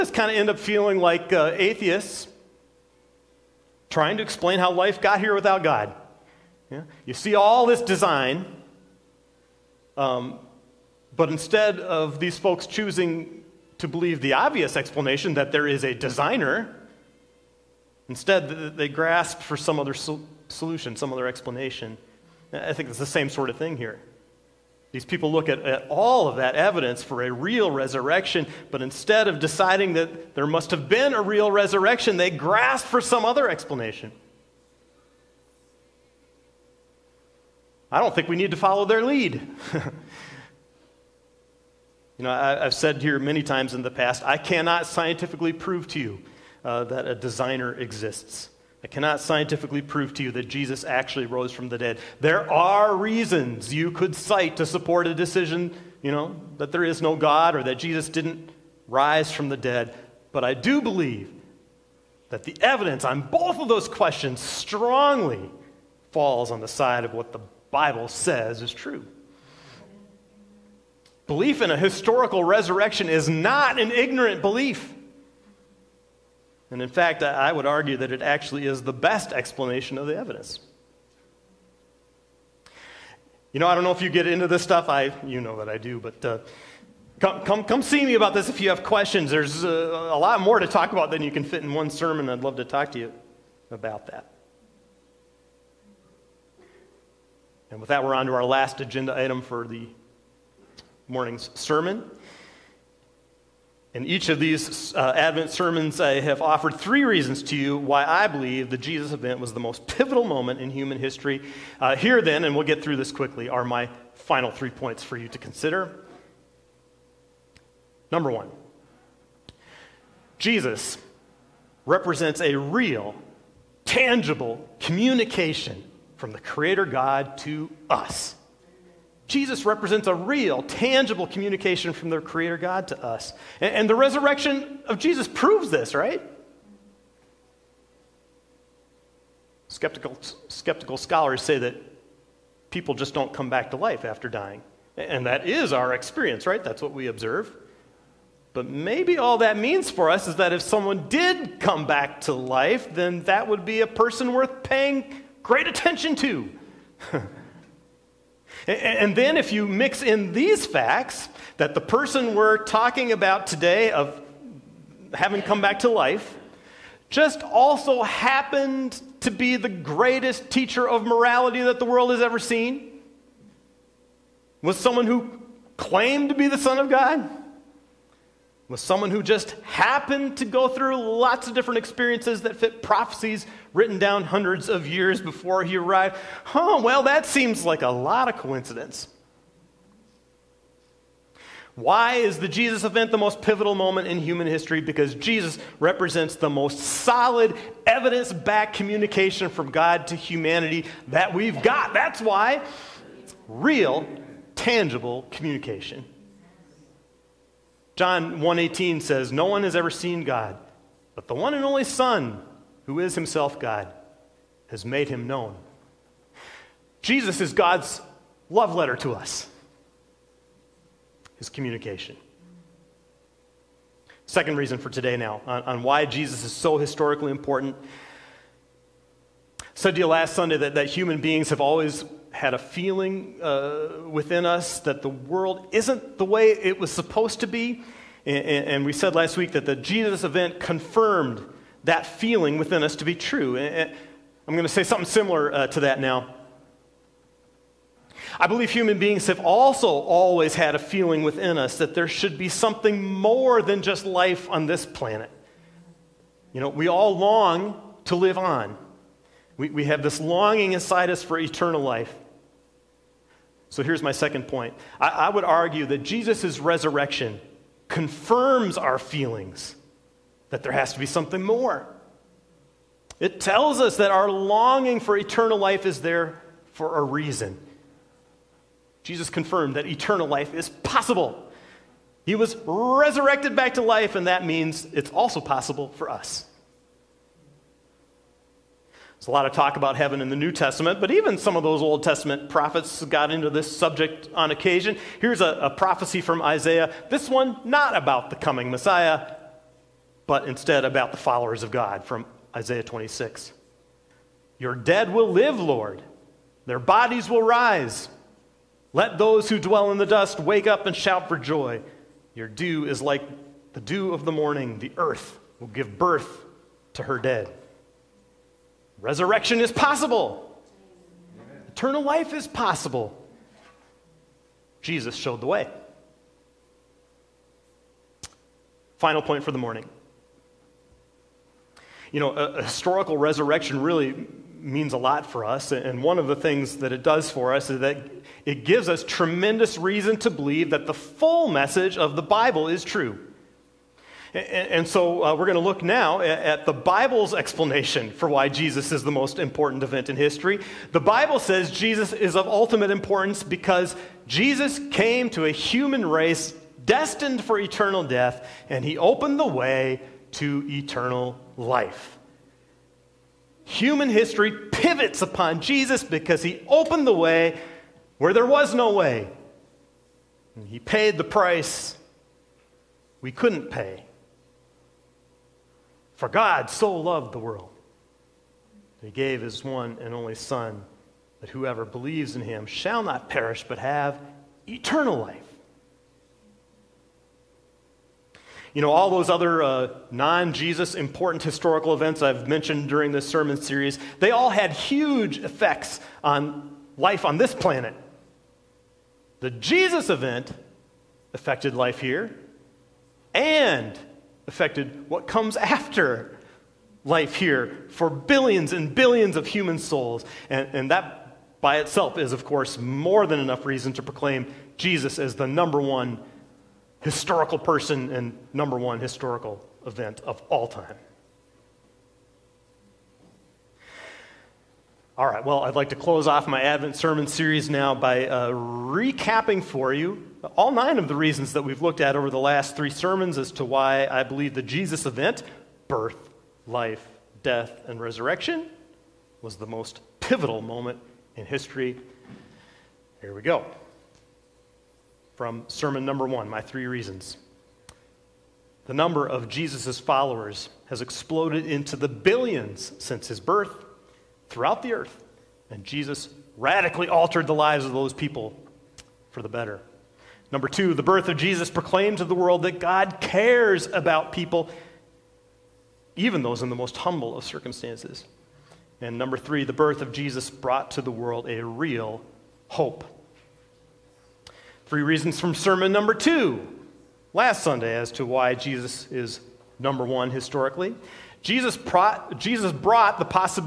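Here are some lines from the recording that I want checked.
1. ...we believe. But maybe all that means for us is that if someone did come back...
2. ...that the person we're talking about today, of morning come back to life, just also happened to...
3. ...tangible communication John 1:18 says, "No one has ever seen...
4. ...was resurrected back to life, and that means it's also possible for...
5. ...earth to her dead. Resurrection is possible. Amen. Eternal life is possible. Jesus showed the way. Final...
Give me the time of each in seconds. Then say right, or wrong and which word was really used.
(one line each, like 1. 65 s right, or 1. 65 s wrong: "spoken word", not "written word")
1. 146 s wrong: "observe", not "believe"
2. 161 s wrong: "having", not "morning"
3. 204 s right
4. 282 s right
5. 315 s wrong: "birth", not "earth".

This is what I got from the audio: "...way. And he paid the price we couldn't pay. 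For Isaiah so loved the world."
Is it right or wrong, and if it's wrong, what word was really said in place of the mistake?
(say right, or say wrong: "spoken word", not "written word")
wrong: "God", not "Isaiah".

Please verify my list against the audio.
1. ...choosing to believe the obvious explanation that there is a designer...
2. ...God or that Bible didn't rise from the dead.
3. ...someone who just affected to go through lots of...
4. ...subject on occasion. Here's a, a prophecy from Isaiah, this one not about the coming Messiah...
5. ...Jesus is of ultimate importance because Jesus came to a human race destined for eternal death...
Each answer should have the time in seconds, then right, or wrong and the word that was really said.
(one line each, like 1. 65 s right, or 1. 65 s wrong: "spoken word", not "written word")
1. 12 s right
2. 57 s wrong: "Jesus", not "Bible"
3. 178 s wrong: "happened", not "affected"
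4. 293 s right
5. 351 s right.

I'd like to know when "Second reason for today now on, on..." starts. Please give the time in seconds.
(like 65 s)
224 s.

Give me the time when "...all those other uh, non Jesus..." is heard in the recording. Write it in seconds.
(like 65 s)
388 s.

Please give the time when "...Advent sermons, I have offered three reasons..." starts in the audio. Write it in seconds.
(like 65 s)
105 s.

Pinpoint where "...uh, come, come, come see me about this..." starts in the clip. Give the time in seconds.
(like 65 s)
86 s.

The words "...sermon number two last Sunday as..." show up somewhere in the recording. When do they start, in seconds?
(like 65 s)
475 s.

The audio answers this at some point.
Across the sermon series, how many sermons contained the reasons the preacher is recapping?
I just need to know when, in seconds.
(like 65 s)
432 s.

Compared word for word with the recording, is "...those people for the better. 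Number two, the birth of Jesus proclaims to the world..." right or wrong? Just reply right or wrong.
right.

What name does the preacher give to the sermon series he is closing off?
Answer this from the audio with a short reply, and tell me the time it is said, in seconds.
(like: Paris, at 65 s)
Advent sermon series, at 426 s.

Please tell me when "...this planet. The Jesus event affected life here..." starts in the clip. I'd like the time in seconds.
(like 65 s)
397 s.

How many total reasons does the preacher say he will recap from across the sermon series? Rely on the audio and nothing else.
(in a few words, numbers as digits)
9.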